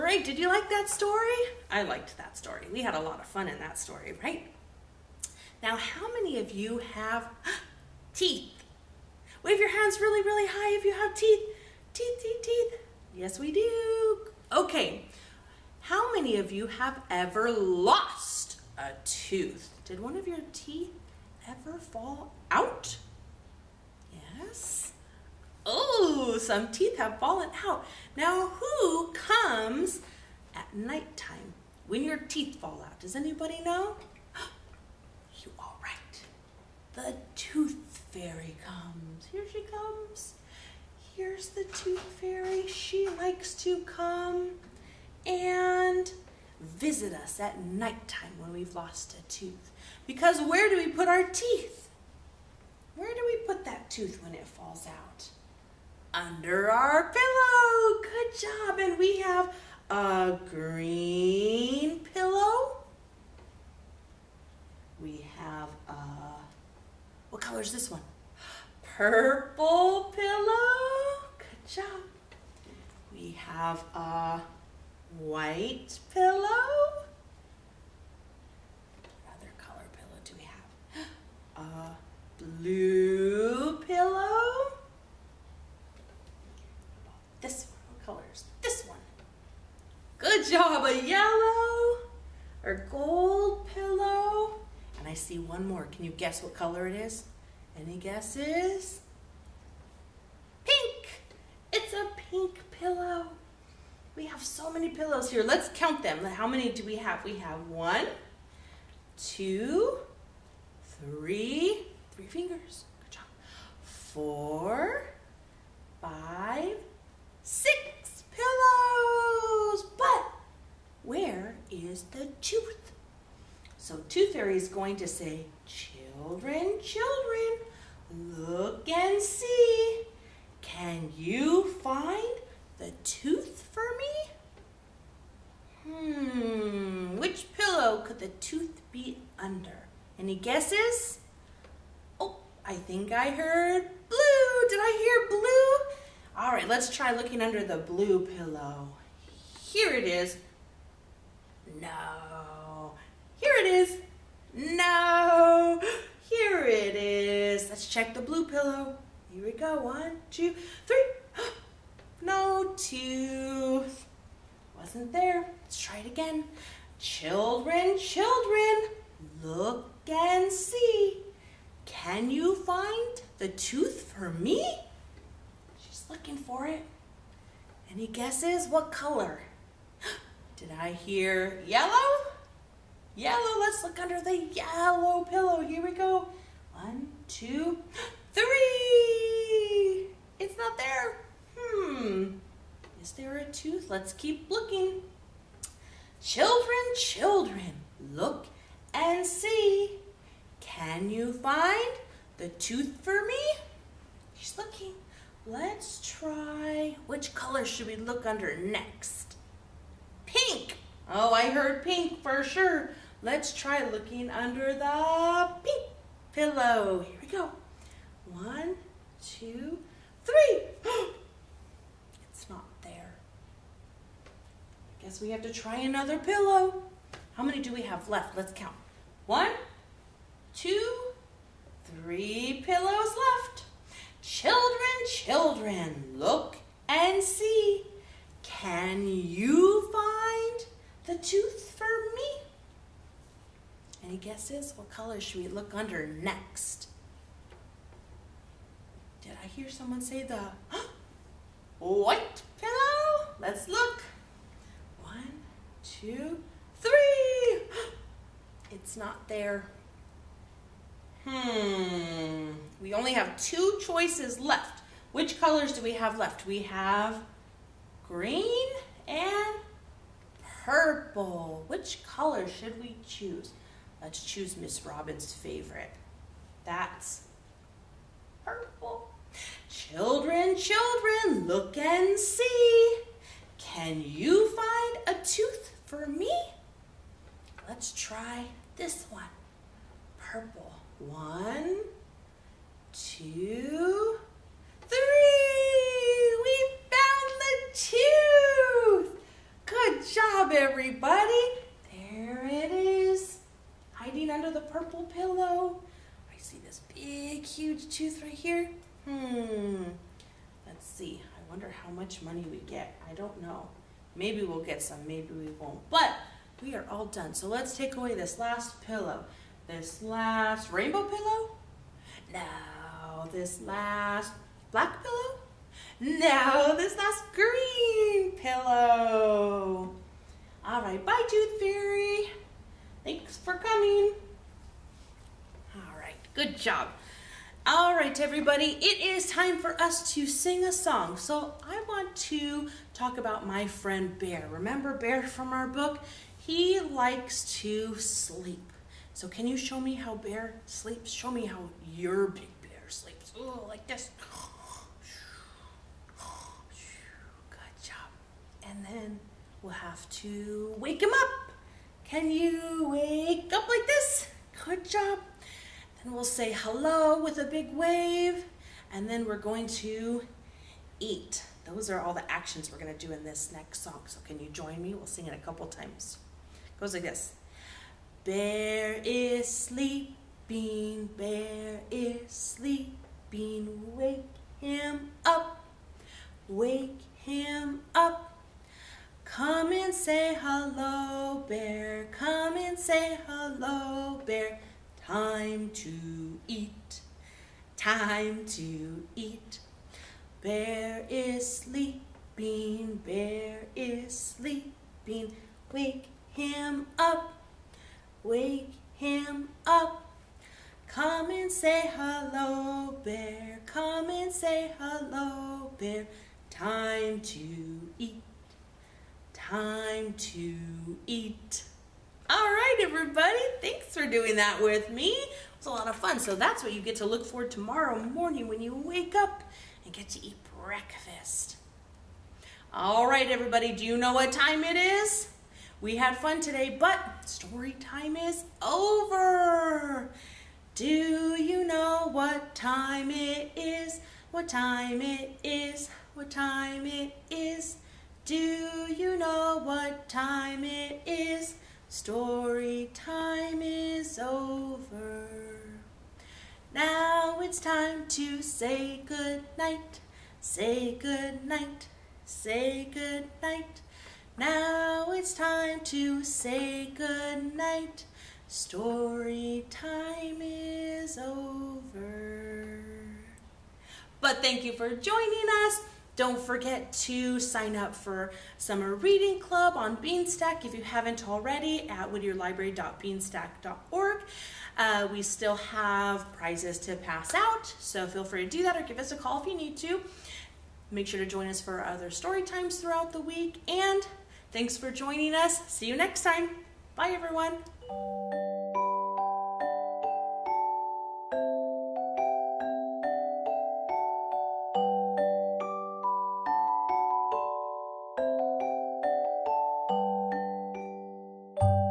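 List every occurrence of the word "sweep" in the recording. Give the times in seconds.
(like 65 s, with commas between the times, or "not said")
not said.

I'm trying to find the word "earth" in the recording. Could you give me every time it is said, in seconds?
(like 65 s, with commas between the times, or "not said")
not said.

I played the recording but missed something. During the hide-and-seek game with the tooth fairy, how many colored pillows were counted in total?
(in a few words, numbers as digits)
6.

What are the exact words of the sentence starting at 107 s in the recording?
We have one, two, three, three fingers.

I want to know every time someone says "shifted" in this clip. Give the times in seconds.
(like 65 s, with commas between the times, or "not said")
not said.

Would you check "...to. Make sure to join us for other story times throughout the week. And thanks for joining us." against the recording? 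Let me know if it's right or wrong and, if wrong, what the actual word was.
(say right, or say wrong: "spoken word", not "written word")
right.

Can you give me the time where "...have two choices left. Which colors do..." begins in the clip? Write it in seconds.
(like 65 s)
263 s.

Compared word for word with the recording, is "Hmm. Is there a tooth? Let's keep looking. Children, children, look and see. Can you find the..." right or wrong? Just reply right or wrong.
right.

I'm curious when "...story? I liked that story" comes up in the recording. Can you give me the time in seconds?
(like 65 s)
0 s.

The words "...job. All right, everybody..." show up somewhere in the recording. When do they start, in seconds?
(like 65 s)
336 s.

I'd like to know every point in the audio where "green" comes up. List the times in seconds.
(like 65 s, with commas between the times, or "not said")
60 s, 268 s, 327 s.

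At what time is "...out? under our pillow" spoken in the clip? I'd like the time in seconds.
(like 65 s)
54 s.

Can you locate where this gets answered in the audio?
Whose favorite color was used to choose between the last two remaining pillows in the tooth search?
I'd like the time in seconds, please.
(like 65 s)
274 s.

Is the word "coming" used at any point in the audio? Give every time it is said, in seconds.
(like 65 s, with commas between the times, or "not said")
333 s.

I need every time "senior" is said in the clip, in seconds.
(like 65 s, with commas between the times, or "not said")
not said.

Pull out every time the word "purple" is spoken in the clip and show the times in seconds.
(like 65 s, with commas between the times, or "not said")
68 s, 270 s, 278 s, 290 s, 304 s.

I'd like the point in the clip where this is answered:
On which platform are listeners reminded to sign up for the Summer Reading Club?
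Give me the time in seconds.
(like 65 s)
479 s.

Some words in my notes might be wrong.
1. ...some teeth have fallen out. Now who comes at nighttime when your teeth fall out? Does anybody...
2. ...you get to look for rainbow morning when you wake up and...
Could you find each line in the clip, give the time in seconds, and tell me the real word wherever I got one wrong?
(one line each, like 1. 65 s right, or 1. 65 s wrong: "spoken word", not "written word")
1. 26 s right
2. 426 s wrong: "tomorrow", not "rainbow".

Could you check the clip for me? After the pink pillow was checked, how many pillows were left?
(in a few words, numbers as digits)
3.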